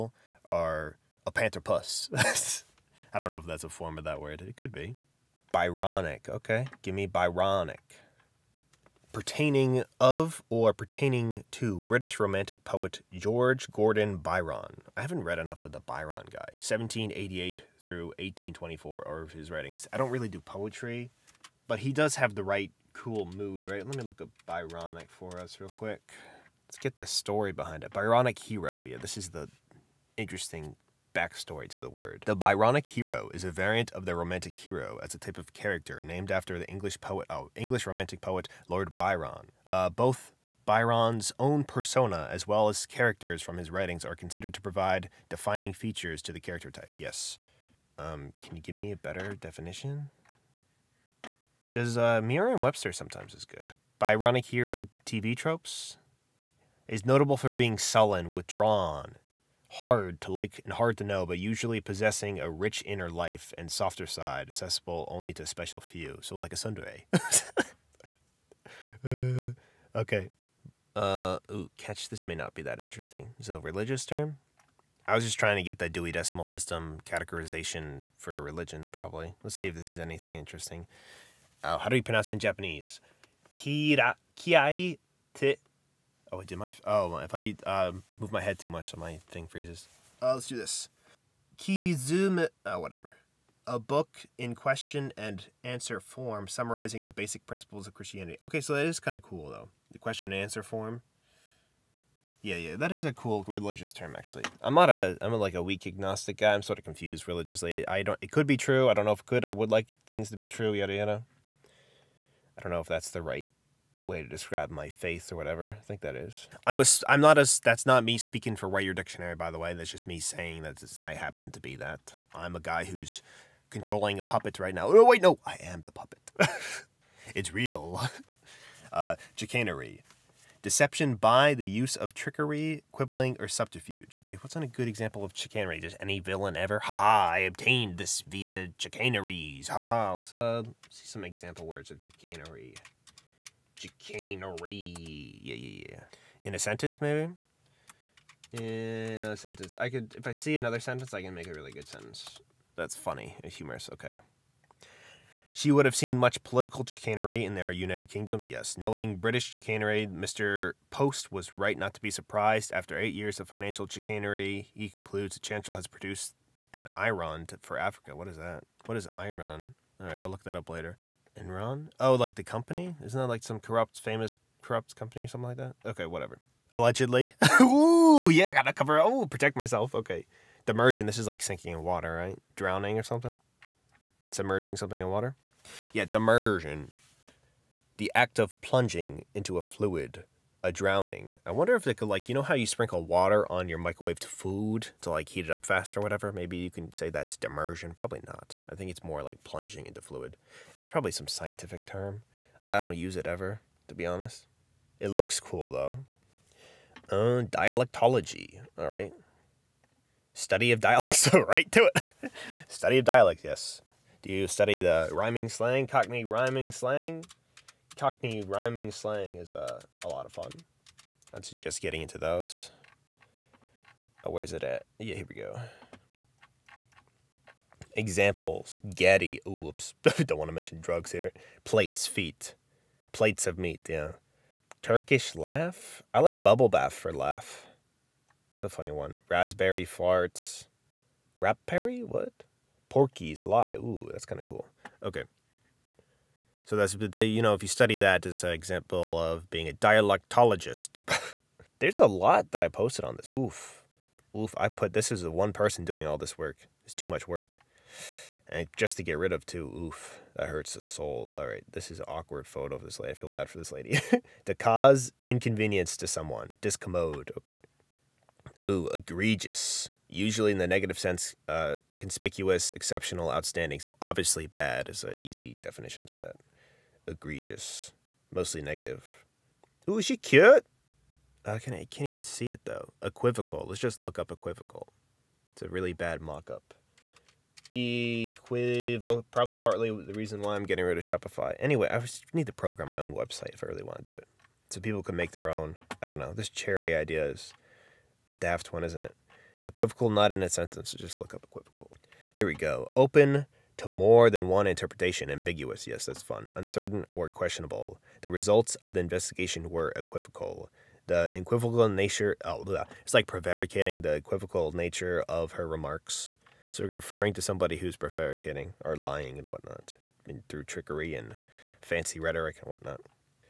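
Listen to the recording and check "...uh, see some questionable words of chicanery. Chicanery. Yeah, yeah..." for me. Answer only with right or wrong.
wrong.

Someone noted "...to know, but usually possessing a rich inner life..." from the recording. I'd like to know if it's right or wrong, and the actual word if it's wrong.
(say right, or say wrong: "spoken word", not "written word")
right.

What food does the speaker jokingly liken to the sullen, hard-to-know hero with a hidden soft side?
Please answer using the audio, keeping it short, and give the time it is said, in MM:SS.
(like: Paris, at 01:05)
a sundae, at 01:06.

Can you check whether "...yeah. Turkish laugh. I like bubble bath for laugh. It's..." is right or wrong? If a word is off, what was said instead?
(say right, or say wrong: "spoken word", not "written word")
right.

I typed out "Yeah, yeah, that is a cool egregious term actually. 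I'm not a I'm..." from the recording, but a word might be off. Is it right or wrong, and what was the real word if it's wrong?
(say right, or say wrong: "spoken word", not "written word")
wrong: "religious", not "egregious".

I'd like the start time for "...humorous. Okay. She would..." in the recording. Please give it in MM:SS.
02:33.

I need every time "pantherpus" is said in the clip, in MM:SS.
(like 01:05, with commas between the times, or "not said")
00:01.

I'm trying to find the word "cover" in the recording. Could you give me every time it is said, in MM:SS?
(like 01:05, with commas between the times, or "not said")
02:58.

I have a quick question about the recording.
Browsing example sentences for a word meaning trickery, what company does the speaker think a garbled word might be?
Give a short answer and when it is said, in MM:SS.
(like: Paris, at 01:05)
Enron, at 02:51.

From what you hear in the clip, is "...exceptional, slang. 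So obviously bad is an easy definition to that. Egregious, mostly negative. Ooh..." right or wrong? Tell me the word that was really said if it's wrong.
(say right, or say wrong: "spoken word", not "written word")
wrong: "outstanding", not "slang".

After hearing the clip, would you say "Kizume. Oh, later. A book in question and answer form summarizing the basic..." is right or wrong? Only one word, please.
wrong.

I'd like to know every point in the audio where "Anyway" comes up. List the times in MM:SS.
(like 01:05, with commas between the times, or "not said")
04:51.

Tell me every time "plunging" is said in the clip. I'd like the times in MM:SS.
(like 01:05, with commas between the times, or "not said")
03:08, 03:19.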